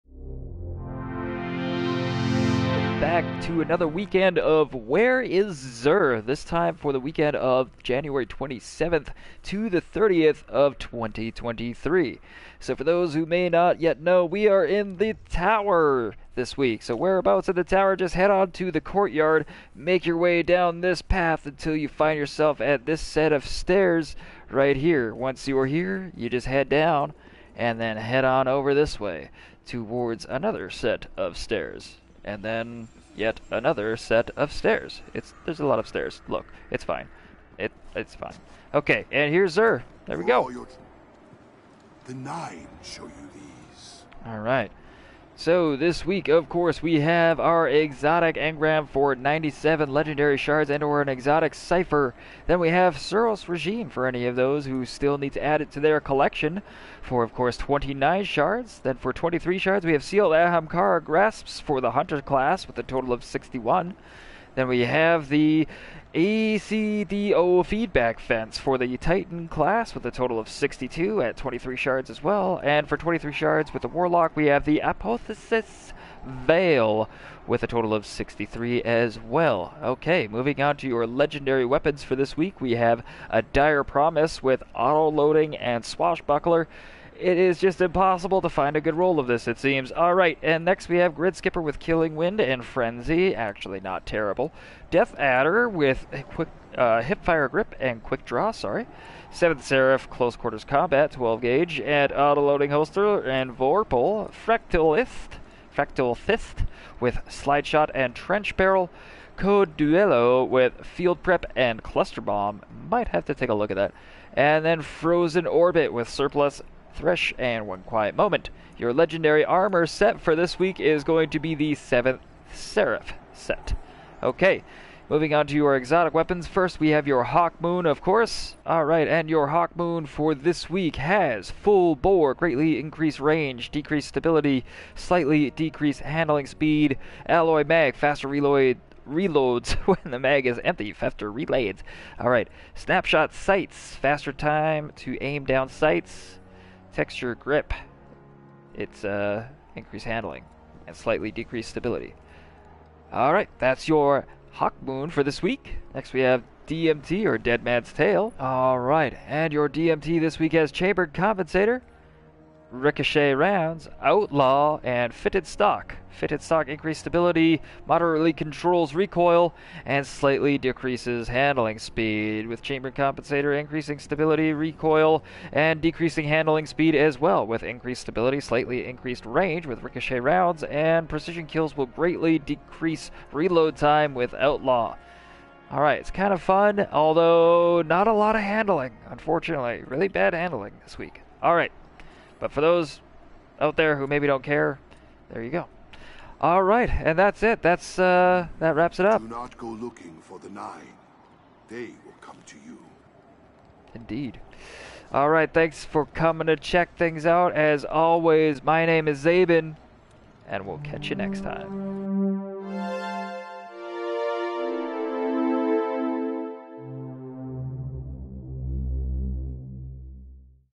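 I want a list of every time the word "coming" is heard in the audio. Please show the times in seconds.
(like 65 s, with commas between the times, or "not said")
206 s.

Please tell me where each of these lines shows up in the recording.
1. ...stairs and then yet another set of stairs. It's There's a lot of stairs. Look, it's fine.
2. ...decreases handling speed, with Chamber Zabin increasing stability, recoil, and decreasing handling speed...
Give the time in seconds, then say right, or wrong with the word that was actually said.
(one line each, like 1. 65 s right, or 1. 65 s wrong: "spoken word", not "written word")
1. 31 s right
2. 170 s wrong: "Compensator", not "Zabin".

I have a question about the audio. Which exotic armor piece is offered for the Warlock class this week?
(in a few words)
Apotheosis Veil.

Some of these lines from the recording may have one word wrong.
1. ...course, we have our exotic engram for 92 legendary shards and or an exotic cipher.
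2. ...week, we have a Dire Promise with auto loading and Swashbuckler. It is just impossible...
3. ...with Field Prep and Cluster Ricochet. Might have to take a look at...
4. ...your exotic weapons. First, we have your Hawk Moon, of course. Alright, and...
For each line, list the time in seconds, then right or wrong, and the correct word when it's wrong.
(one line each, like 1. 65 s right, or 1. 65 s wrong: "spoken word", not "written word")
1. 46 s wrong: "97", not "92"
2. 82 s right
3. 110 s wrong: "Bomb", not "Ricochet"
4. 125 s right.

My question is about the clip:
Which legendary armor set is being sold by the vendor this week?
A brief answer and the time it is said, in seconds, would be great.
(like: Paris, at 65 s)
7th Seraph, at 121 s.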